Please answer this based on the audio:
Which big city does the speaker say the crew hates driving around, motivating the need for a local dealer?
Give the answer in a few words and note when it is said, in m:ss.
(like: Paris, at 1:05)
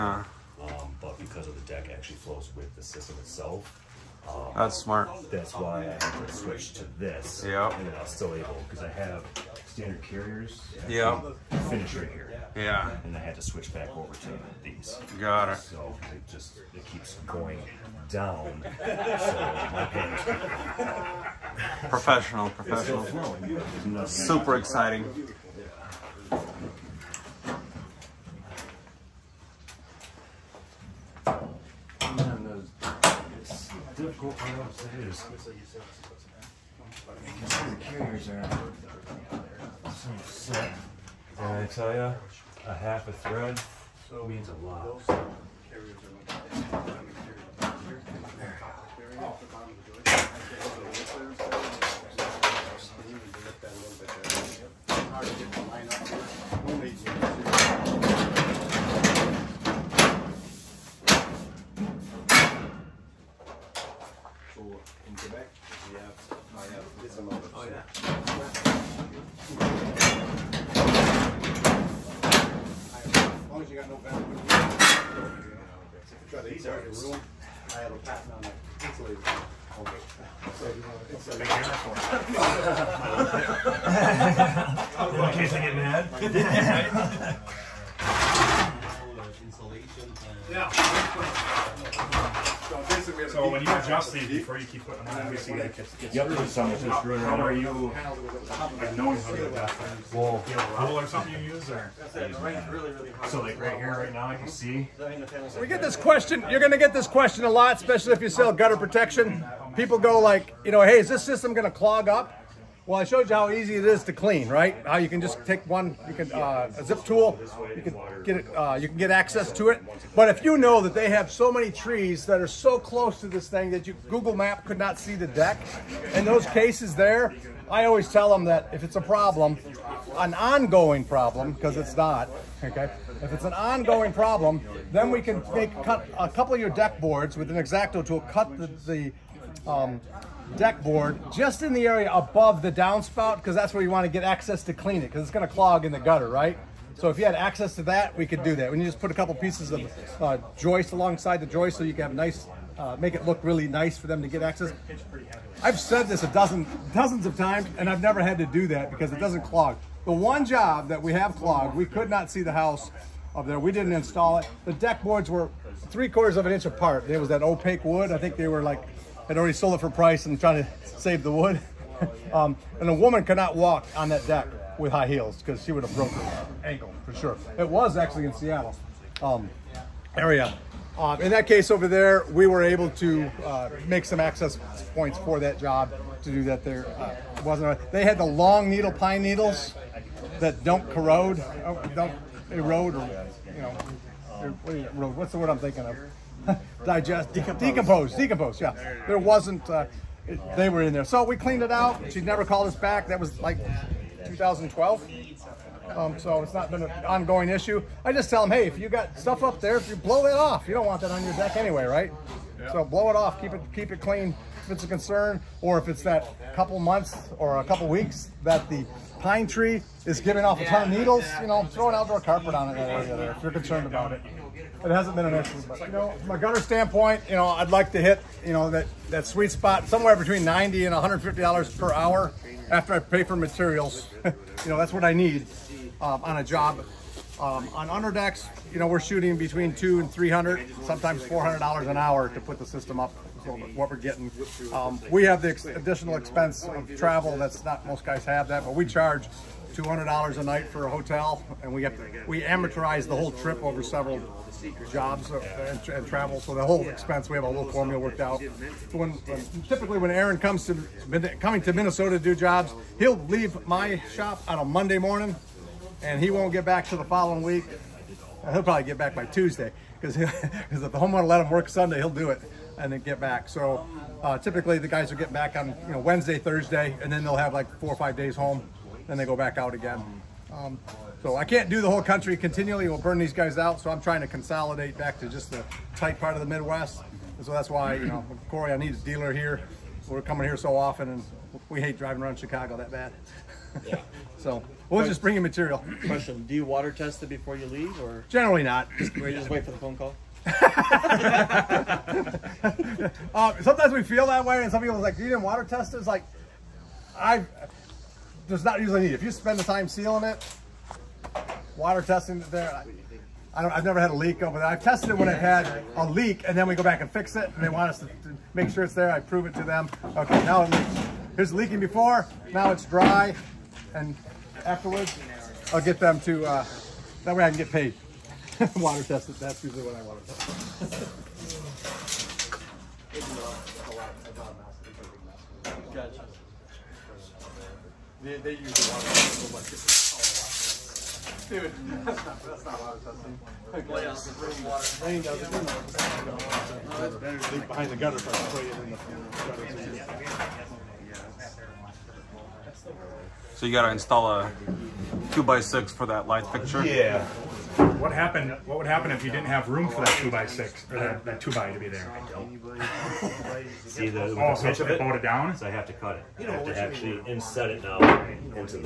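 Chicago, at 4:52.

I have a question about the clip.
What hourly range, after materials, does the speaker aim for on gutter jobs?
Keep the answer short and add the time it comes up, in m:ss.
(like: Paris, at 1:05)
$90 to $150, at 3:50.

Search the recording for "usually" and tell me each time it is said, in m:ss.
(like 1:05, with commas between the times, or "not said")
5:08, 5:29.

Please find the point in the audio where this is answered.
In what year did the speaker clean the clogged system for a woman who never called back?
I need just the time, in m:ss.
3:24.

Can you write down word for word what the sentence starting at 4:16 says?
So the whole expense, we have a little formula worked out.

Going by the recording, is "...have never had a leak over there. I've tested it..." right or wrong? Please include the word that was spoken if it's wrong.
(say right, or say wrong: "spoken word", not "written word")
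right.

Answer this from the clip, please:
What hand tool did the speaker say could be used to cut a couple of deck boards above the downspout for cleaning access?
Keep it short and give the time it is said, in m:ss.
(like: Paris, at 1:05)
X-Acto tool, at 2:17.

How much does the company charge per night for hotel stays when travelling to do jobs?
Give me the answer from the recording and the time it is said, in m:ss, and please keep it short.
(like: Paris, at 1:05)
$200, at 4:09.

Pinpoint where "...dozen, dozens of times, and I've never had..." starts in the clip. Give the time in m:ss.
2:36.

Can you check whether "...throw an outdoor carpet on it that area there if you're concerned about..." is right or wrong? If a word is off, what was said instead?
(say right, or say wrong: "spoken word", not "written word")
right.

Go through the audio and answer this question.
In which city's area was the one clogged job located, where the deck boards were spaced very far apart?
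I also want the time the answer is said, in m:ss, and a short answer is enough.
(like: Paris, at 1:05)
Seattle, at 2:58.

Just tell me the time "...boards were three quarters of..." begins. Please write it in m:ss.
2:45.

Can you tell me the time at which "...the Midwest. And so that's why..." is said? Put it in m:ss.
4:46.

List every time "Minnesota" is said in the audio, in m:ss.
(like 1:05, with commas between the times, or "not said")
4:21.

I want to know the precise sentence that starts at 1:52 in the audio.
Well, I showed you how easy it is to clean, right?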